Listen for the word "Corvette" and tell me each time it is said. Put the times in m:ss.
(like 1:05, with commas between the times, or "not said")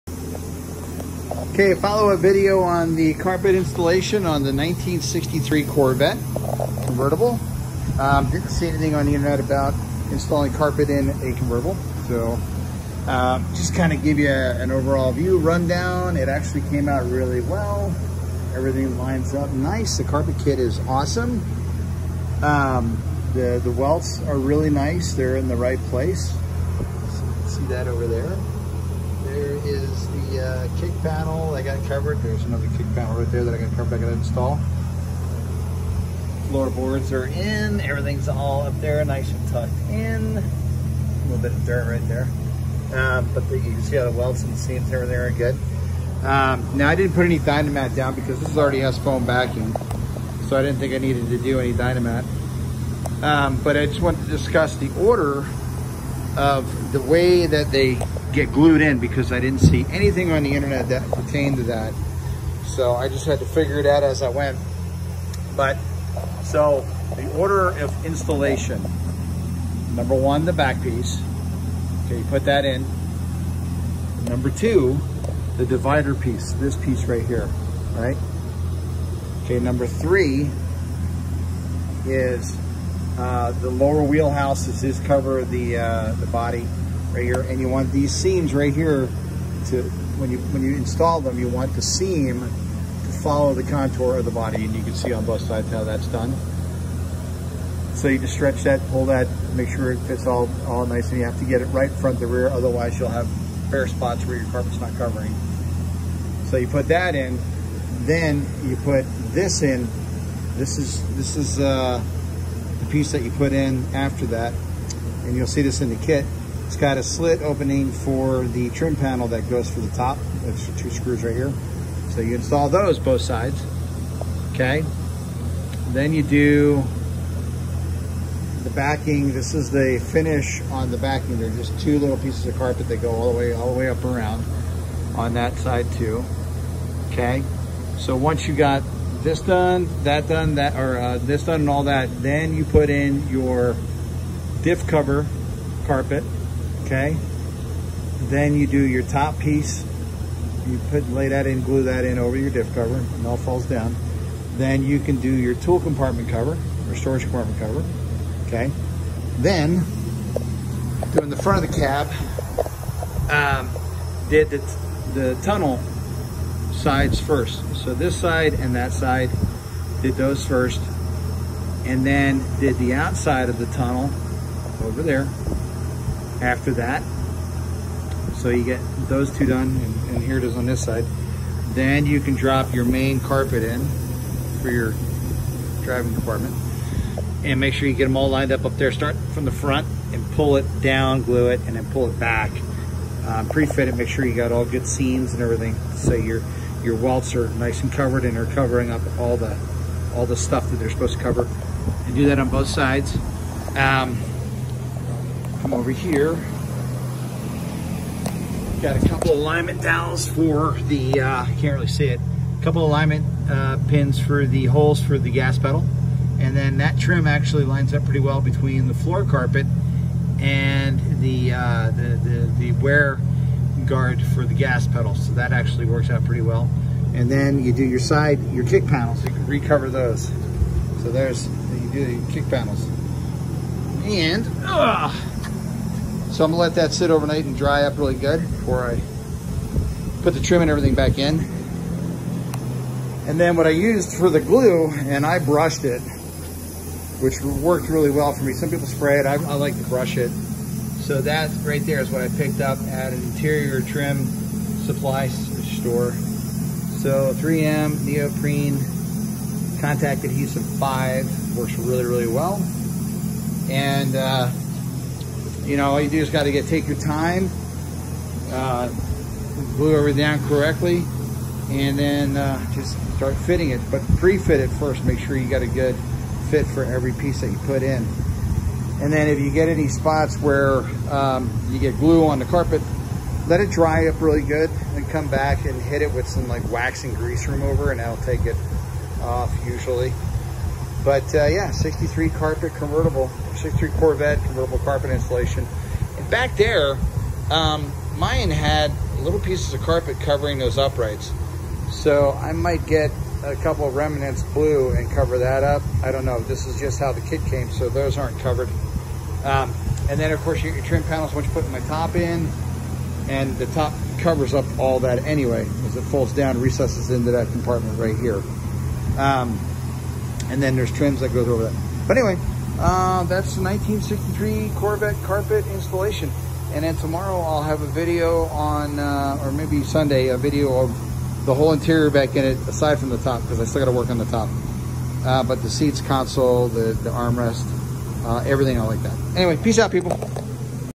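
0:05, 4:53, 5:24.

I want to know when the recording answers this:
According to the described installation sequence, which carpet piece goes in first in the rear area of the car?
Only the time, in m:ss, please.
1:10.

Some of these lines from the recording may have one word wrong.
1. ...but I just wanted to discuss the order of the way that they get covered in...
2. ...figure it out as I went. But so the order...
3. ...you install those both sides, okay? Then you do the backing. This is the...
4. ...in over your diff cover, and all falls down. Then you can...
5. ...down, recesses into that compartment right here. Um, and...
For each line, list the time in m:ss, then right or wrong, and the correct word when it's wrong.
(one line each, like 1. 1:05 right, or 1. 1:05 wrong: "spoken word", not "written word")
1. 0:53 wrong: "glued", not "covered"
2. 1:03 right
3. 2:02 right
4. 2:32 right
5. 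5:16 right.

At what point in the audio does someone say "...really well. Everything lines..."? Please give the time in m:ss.
0:17.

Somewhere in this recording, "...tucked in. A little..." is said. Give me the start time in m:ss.
0:39.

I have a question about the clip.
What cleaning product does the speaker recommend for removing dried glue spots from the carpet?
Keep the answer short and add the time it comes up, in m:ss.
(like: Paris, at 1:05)
Wax and grease remover, at 4:46.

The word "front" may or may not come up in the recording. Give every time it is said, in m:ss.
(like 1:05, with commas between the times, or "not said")
1:41, 2:41, 3:09.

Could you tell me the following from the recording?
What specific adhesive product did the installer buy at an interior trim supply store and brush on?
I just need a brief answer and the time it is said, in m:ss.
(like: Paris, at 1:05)
3M neoprene contact adhesive, at 4:17.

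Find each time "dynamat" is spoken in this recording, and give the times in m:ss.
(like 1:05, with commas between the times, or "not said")
0:47, 0:51.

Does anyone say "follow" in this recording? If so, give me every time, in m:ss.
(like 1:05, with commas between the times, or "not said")
0:01, 1:33.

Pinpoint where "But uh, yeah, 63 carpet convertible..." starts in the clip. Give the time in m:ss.
4:51.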